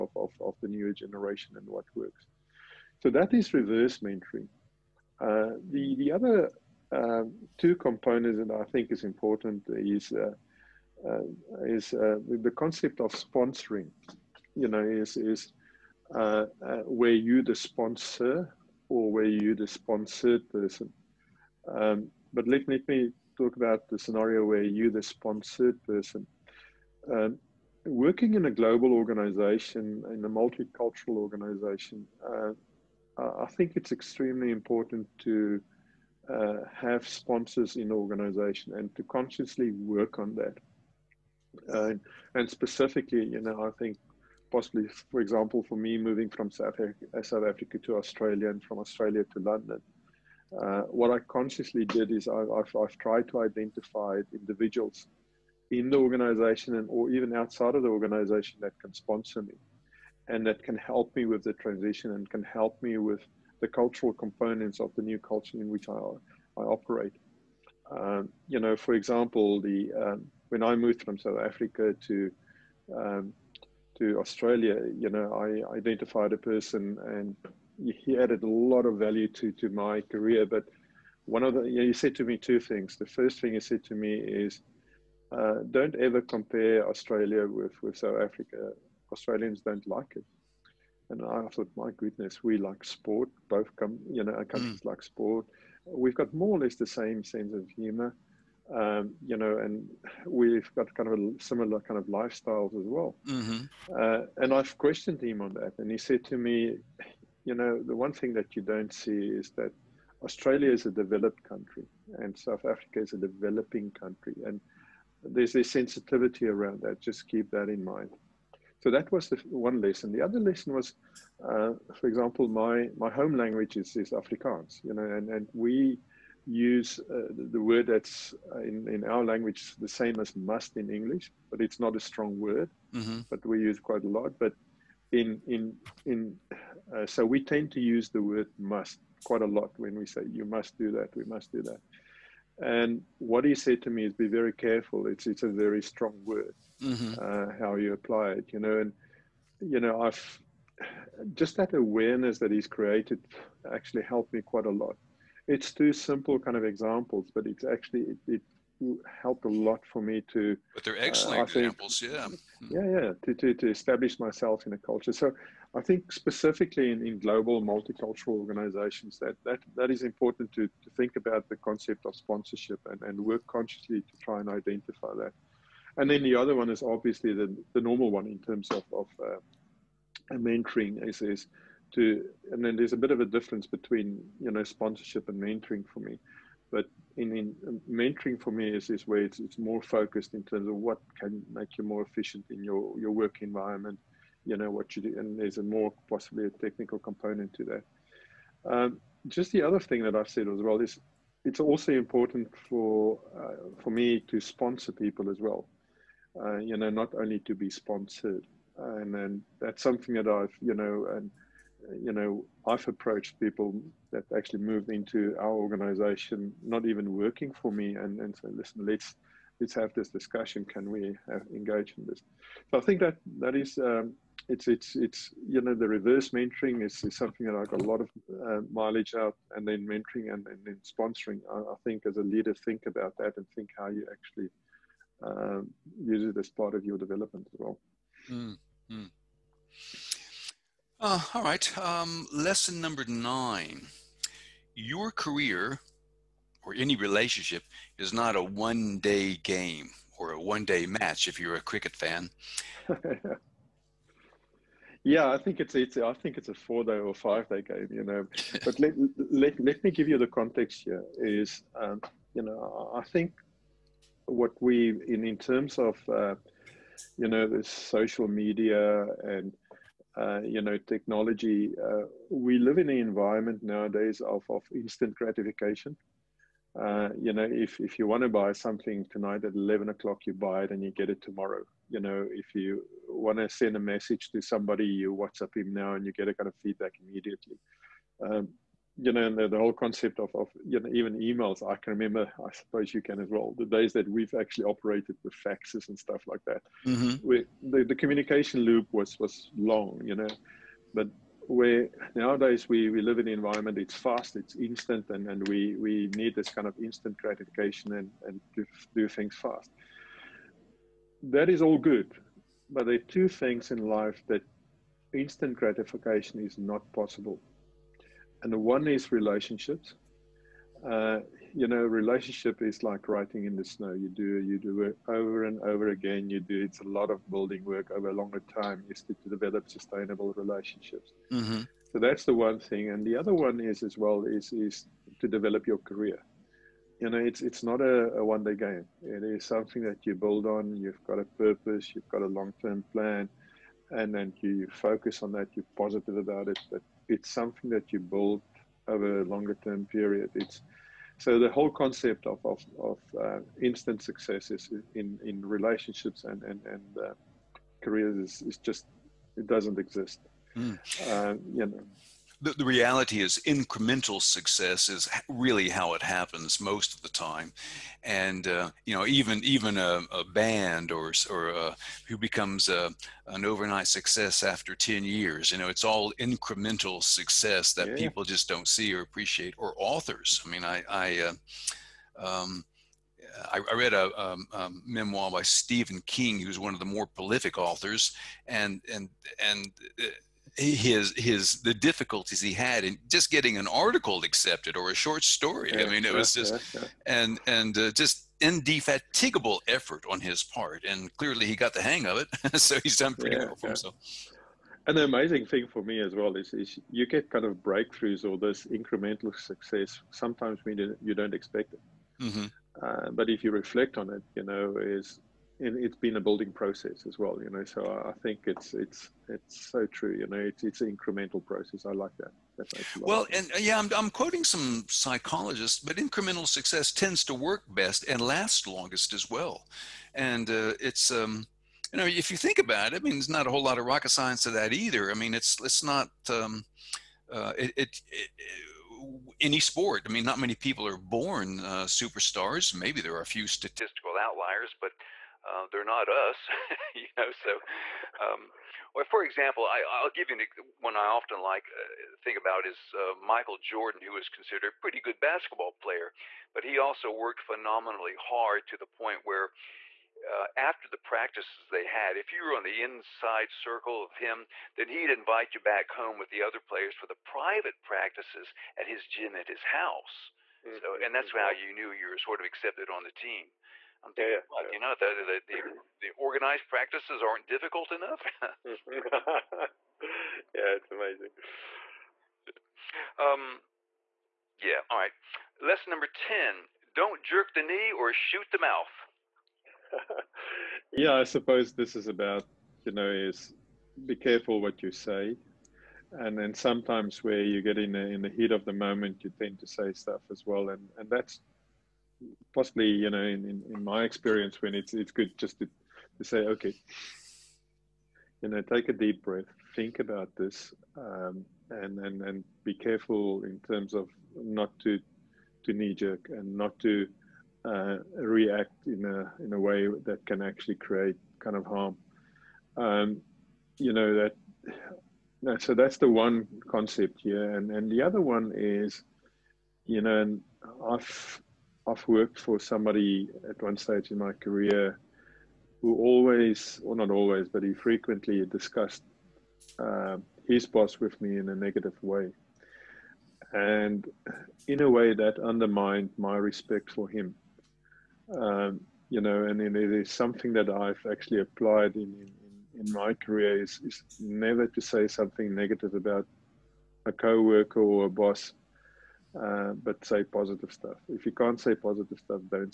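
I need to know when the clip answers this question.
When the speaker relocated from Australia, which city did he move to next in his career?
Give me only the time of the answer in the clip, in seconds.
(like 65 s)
49 s.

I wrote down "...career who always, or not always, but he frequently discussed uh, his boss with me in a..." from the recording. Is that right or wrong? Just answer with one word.
right.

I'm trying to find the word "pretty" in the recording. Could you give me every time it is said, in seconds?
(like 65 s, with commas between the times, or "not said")
403 s, 454 s.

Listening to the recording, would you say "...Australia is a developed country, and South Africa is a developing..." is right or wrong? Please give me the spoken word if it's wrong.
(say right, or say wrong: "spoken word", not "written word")
right.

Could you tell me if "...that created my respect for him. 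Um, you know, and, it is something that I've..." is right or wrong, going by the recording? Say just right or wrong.
wrong.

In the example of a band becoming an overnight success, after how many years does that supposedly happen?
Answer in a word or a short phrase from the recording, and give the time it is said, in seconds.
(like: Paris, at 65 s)
10 years, at 374 s.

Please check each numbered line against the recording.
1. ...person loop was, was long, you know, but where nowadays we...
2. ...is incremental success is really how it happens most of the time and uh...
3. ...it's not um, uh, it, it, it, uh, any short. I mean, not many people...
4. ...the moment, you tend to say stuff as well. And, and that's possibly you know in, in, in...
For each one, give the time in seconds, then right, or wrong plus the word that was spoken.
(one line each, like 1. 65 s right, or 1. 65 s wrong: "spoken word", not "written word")
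1. 297 s wrong: "communication", not "person"
2. 363 s right
3. 435 s wrong: "sport", not "short"
4. 498 s right.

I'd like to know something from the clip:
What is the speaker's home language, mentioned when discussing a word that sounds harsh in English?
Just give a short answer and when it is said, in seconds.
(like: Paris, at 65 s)
Afrikaans, at 124 s.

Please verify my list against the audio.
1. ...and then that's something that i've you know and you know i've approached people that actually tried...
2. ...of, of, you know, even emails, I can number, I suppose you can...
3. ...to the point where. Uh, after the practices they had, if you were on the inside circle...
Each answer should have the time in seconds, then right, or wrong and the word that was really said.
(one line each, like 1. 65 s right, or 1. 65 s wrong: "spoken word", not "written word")
1. 208 s wrong: "moved", not "tried"
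2. 290 s wrong: "remember", not "number"
3. 458 s right.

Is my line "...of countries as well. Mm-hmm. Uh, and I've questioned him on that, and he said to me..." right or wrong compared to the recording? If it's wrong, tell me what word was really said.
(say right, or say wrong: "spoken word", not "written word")
wrong: "lifestyles", not "countries".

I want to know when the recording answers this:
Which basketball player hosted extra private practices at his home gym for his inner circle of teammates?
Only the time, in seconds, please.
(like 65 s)
453 s.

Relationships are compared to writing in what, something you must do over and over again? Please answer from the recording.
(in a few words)
snow.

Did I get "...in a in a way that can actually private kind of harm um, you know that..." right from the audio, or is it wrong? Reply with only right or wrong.
wrong.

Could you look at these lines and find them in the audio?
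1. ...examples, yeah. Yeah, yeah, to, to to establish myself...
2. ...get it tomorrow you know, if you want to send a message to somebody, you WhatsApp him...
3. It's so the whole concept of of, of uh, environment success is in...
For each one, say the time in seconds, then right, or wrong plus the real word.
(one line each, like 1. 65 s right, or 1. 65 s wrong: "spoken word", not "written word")
1. 161 s right
2. 280 s right
3. 350 s wrong: "instant", not "environment".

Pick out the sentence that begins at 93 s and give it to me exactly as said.
Both come, you know, our countries mm.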